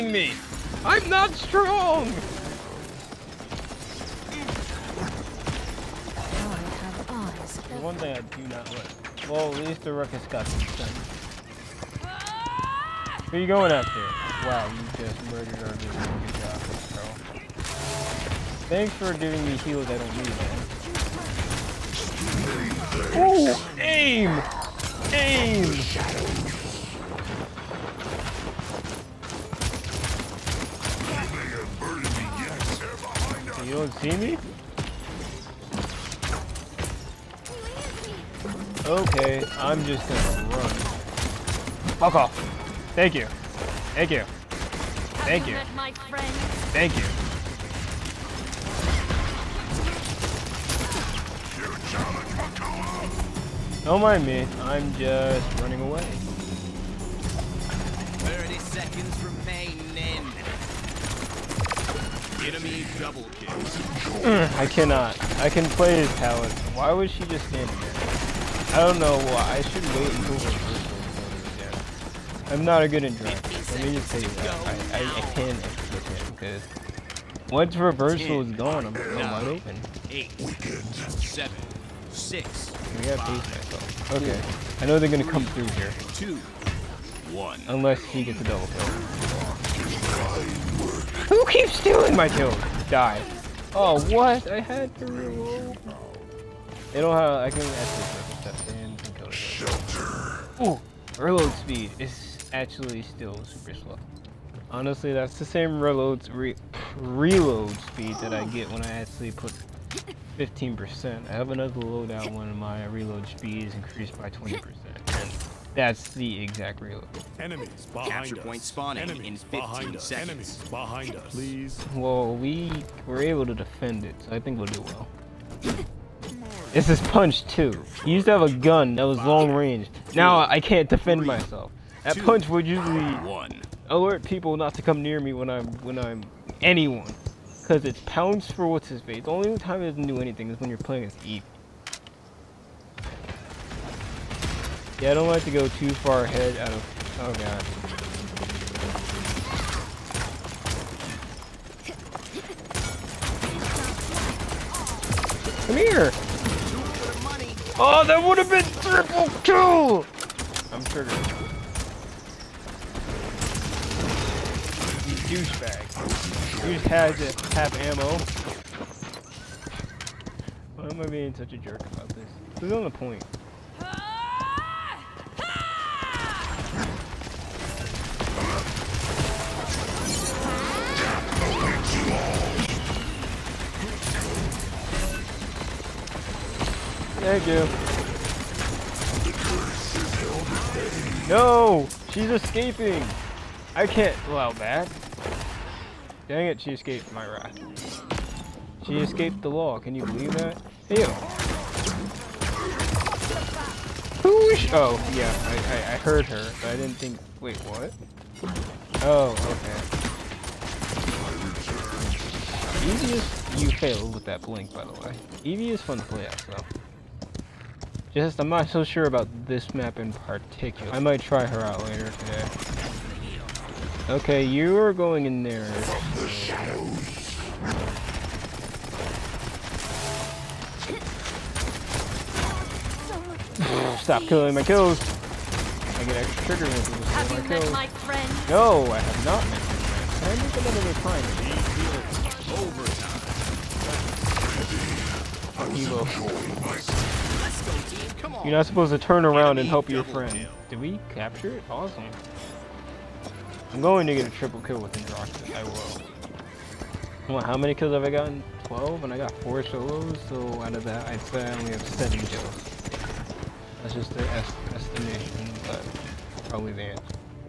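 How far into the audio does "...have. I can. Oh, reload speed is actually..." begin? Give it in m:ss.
1:37.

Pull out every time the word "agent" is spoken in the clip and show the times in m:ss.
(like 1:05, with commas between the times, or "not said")
not said.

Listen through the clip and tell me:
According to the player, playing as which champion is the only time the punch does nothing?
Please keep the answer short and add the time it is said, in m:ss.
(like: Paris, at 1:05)
Eve, at 2:21.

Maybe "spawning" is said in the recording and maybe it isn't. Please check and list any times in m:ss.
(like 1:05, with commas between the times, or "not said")
1:58.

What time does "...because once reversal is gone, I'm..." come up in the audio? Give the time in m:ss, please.
1:16.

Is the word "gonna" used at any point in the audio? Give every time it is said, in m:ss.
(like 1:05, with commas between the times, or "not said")
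0:40, 1:25.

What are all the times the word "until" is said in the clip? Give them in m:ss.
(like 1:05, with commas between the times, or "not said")
1:10.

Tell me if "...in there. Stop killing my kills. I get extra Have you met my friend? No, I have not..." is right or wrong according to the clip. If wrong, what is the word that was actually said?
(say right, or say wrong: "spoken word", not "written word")
right.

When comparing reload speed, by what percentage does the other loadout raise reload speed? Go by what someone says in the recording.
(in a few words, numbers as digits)
20%.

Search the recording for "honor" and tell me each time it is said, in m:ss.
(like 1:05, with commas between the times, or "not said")
not said.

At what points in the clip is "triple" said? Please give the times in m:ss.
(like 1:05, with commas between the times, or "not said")
2:38, 4:14.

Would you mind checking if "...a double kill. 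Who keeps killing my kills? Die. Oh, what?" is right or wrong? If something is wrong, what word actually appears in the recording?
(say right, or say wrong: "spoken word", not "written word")
wrong: "stealing", not "killing".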